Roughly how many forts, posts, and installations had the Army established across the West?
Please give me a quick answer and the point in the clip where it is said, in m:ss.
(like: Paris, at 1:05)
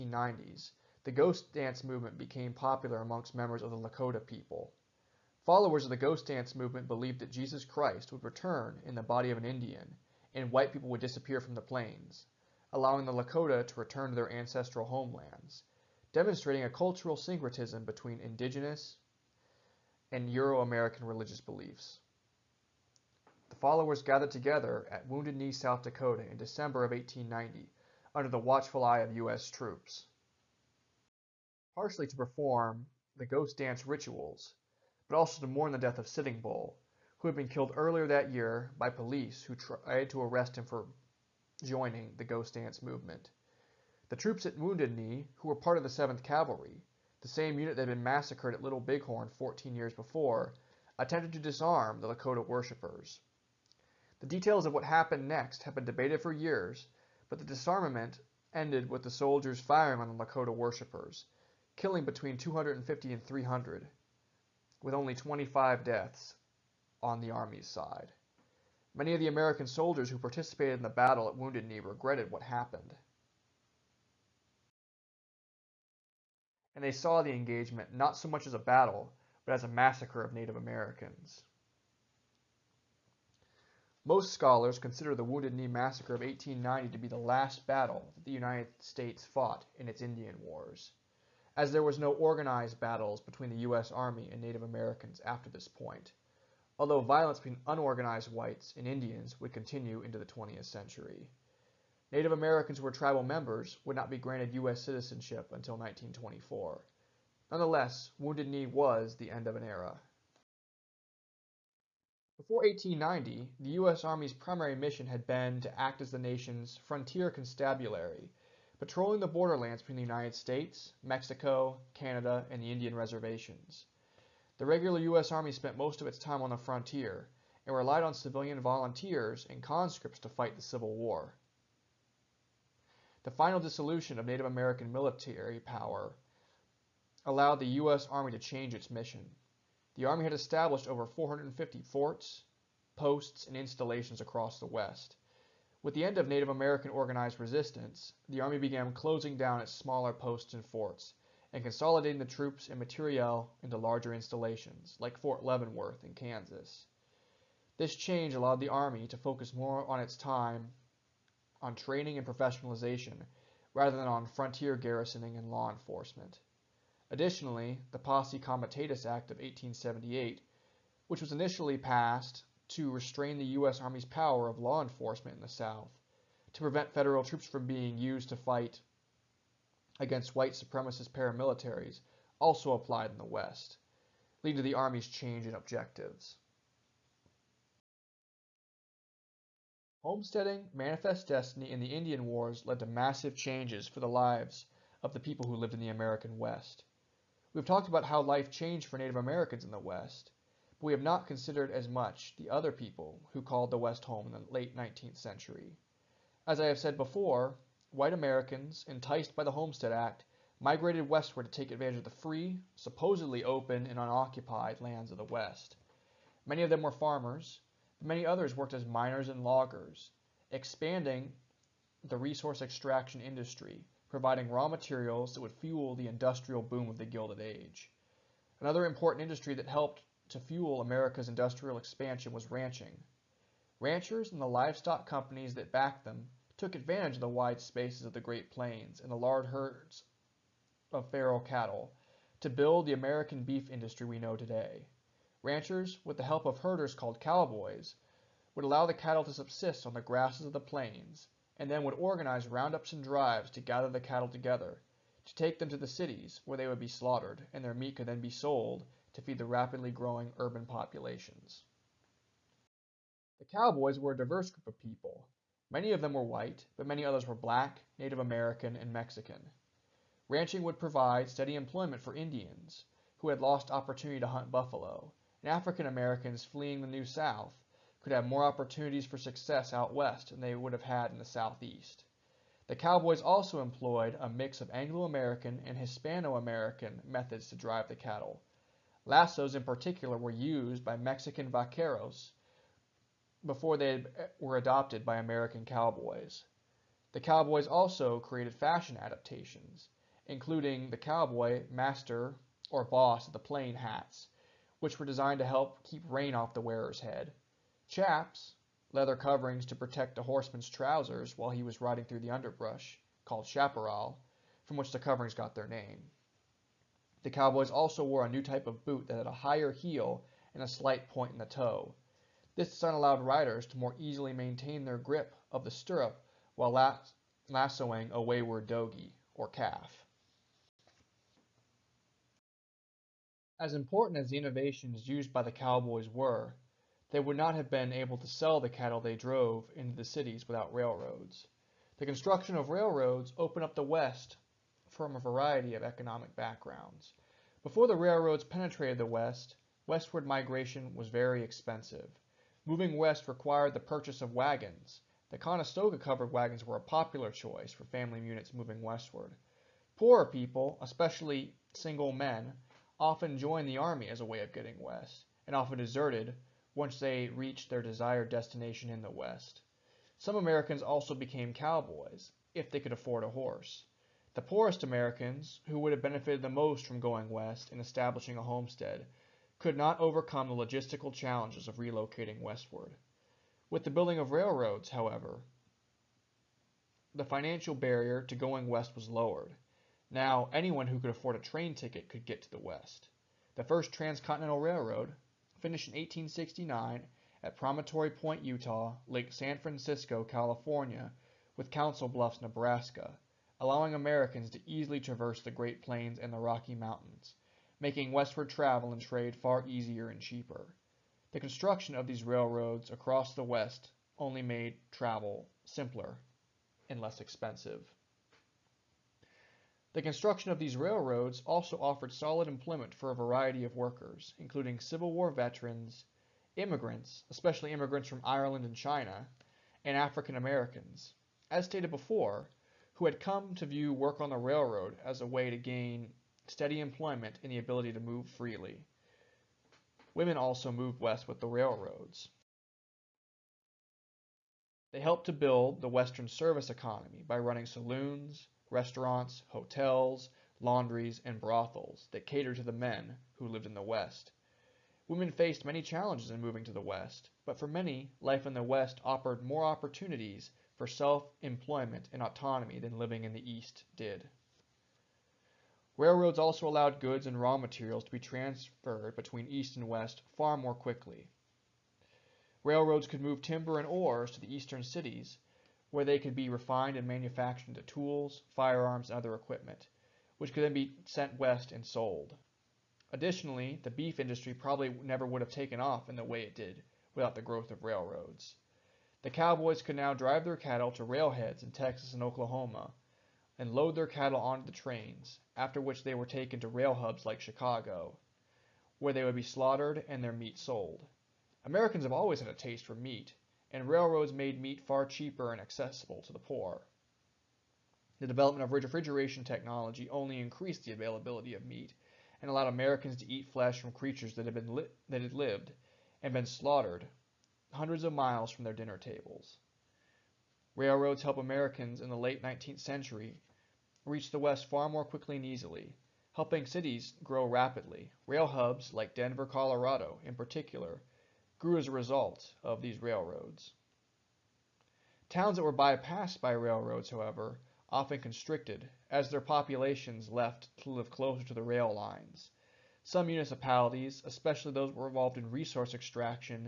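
over 450, at 2:20.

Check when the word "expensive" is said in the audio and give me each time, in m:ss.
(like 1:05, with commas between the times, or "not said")
5:51, 6:57.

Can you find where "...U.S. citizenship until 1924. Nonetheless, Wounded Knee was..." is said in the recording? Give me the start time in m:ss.
1:44.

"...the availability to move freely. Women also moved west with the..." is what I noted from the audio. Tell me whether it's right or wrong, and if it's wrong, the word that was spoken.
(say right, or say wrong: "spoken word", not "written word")
wrong: "ability", not "availability".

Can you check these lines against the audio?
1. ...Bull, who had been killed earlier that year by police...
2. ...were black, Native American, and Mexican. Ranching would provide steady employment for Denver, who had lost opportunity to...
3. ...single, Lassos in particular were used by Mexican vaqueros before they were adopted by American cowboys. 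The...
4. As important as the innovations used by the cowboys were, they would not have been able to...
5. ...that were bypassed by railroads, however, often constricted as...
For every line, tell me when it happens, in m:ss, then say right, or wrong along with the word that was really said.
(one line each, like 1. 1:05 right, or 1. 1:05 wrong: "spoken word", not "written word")
1. 0:36 right
2. 4:27 wrong: "Indians", not "Denver"
3. 4:47 wrong: "cattle", not "single"
4. 5:33 right
5. 8:55 right.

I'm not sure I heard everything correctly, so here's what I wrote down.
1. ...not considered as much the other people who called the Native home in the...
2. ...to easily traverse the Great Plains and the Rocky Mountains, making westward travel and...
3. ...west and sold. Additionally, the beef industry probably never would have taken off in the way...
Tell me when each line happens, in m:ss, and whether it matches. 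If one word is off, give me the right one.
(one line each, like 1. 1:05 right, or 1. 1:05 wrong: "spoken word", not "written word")
1. 3:21 wrong: "West", not "Native"
2. 6:44 right
3. 8:01 right.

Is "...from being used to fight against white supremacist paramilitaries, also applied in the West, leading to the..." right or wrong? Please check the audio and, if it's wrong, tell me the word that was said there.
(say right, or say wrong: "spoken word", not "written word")
right.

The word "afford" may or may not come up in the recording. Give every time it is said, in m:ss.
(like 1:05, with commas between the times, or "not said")
6:12, 6:31.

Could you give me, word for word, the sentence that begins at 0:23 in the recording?
The followers gathered together at Wounded Knee, South Dakota in December of 1890 under the watchful eye of U.S.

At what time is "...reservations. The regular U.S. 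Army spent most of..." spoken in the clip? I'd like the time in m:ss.
2:02.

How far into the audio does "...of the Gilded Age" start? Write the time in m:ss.
3:46.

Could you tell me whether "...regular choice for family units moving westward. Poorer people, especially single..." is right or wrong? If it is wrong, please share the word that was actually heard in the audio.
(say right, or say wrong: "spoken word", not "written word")
wrong: "popular", not "regular".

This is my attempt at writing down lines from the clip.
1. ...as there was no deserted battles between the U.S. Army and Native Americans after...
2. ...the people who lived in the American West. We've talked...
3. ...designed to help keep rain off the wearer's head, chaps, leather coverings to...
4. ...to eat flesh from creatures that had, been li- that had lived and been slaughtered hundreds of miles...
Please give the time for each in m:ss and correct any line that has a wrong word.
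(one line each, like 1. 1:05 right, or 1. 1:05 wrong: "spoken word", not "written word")
1. 1:31 wrong: "organized", not "deserted"
2. 3:15 right
3. 5:05 right
4. 8:33 right.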